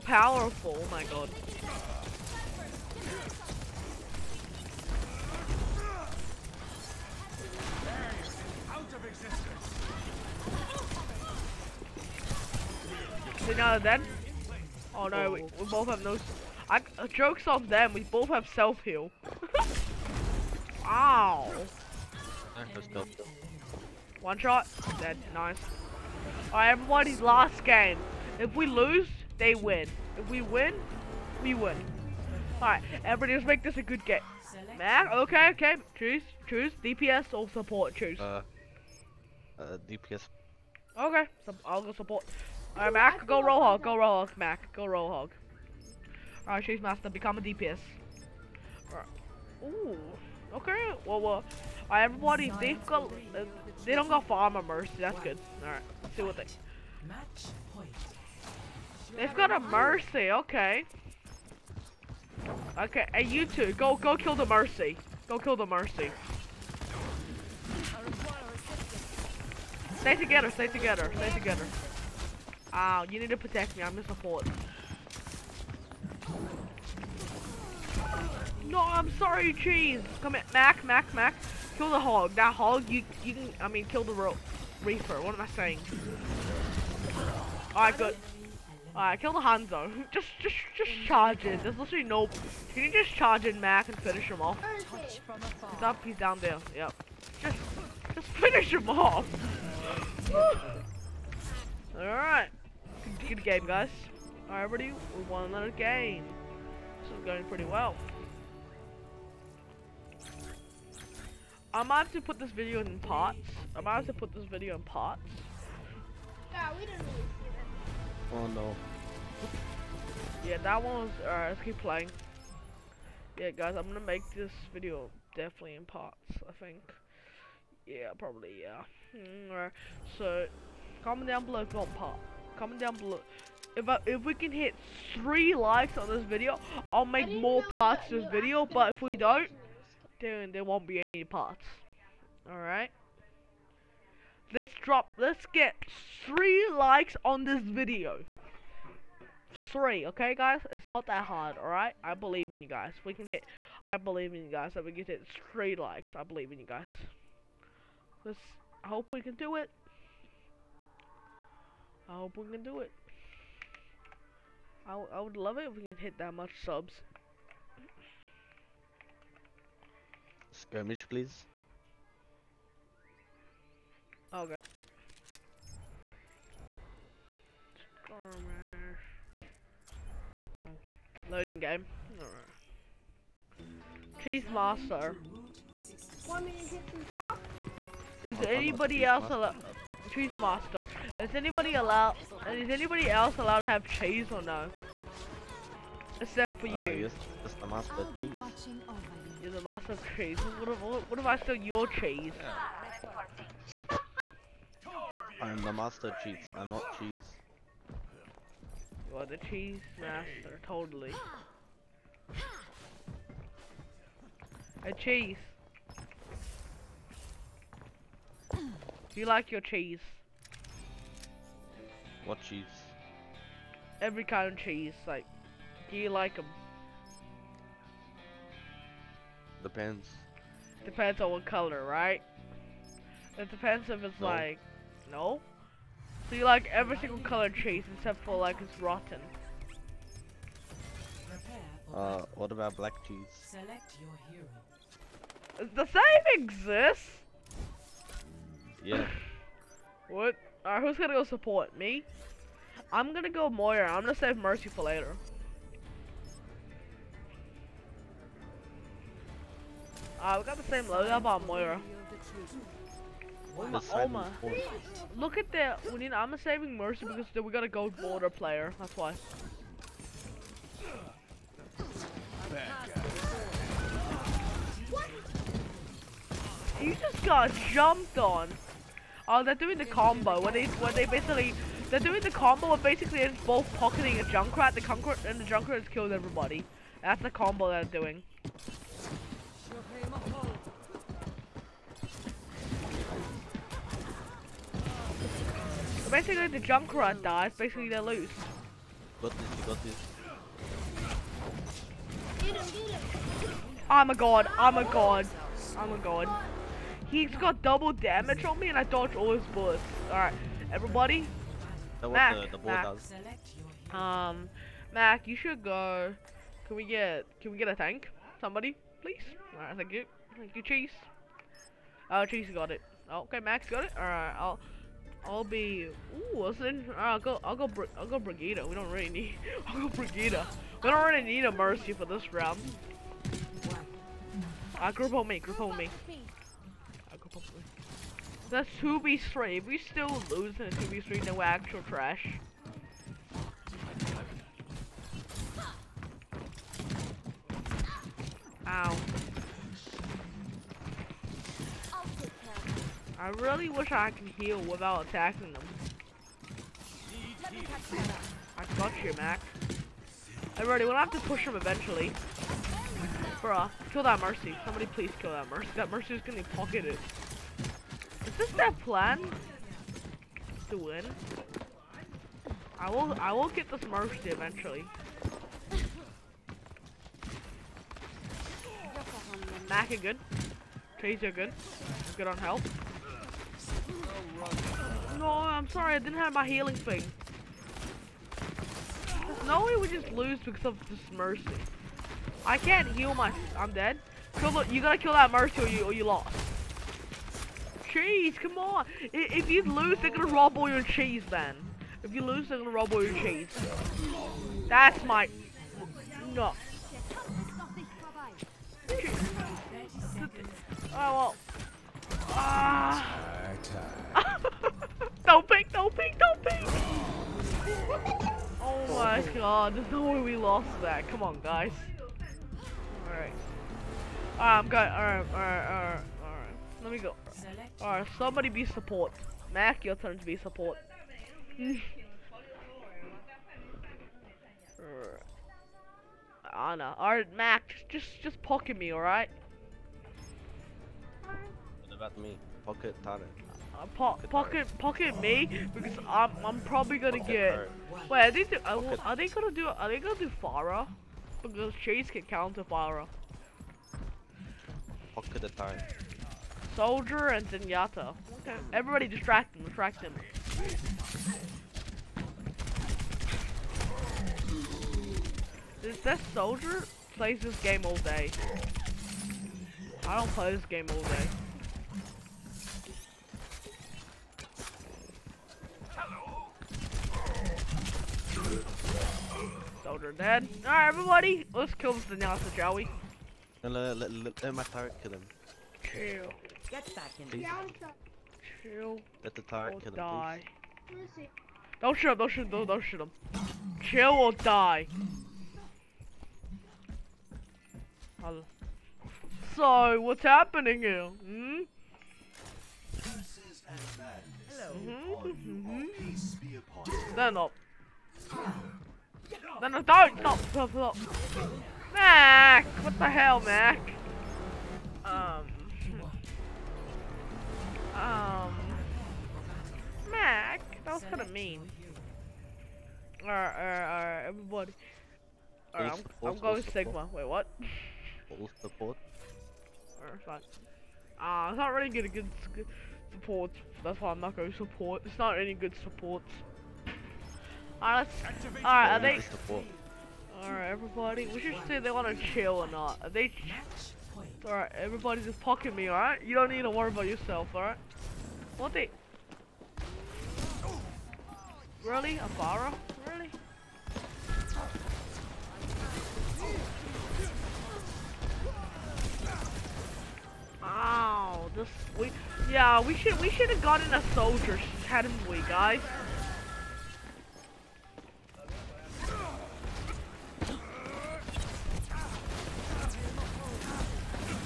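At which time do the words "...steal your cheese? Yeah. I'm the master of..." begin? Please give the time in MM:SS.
03:21.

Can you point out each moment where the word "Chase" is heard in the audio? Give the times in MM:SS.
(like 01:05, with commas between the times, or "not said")
07:31.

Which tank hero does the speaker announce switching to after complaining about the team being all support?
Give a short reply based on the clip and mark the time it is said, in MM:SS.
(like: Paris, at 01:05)
Sigma, at 08:46.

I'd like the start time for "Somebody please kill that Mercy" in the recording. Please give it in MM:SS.
06:04.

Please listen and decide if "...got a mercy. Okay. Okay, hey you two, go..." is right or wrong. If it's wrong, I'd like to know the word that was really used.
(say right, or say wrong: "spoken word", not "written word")
right.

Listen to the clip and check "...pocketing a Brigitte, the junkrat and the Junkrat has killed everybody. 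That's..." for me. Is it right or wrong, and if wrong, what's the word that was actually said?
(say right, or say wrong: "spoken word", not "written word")
wrong: "Junkrat", not "Brigitte".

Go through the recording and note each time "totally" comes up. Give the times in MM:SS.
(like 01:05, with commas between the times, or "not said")
03:30.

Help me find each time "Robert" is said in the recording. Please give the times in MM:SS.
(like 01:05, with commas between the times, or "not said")
not said.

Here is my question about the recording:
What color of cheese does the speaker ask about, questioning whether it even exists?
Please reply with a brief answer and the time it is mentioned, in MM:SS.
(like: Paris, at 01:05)
Black, at 04:02.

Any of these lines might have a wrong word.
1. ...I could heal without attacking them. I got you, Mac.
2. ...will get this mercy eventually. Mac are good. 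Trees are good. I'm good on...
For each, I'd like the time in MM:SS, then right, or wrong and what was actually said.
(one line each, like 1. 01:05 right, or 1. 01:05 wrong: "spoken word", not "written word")
1. 05:53 right
2. 06:13 right.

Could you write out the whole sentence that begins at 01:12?
Ow, you need to protect me, I'm in support.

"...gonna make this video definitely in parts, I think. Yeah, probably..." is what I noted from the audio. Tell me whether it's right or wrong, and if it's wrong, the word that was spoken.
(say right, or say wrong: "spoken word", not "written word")
right.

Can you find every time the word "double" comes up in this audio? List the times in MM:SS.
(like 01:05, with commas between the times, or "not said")
05:07.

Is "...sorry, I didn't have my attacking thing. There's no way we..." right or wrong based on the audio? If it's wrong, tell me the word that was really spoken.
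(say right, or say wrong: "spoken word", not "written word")
wrong: "healing", not "attacking".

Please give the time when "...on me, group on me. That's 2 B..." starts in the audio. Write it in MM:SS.
05:35.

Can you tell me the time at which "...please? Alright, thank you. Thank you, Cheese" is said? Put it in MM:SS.
05:19.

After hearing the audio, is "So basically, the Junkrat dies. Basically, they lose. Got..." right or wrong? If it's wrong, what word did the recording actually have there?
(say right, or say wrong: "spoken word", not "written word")
right.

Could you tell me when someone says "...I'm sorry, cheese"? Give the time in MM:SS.
01:18.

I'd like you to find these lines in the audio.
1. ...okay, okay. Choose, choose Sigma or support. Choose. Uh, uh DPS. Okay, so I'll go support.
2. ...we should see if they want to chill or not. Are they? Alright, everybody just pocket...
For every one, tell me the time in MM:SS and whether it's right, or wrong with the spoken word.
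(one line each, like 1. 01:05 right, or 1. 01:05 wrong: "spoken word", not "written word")
1. 00:35 wrong: "DPS", not "Sigma"
2. 09:01 right.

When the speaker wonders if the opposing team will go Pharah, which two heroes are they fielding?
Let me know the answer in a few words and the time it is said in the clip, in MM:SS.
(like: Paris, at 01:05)
Soldier and Zenyatta, at 07:36.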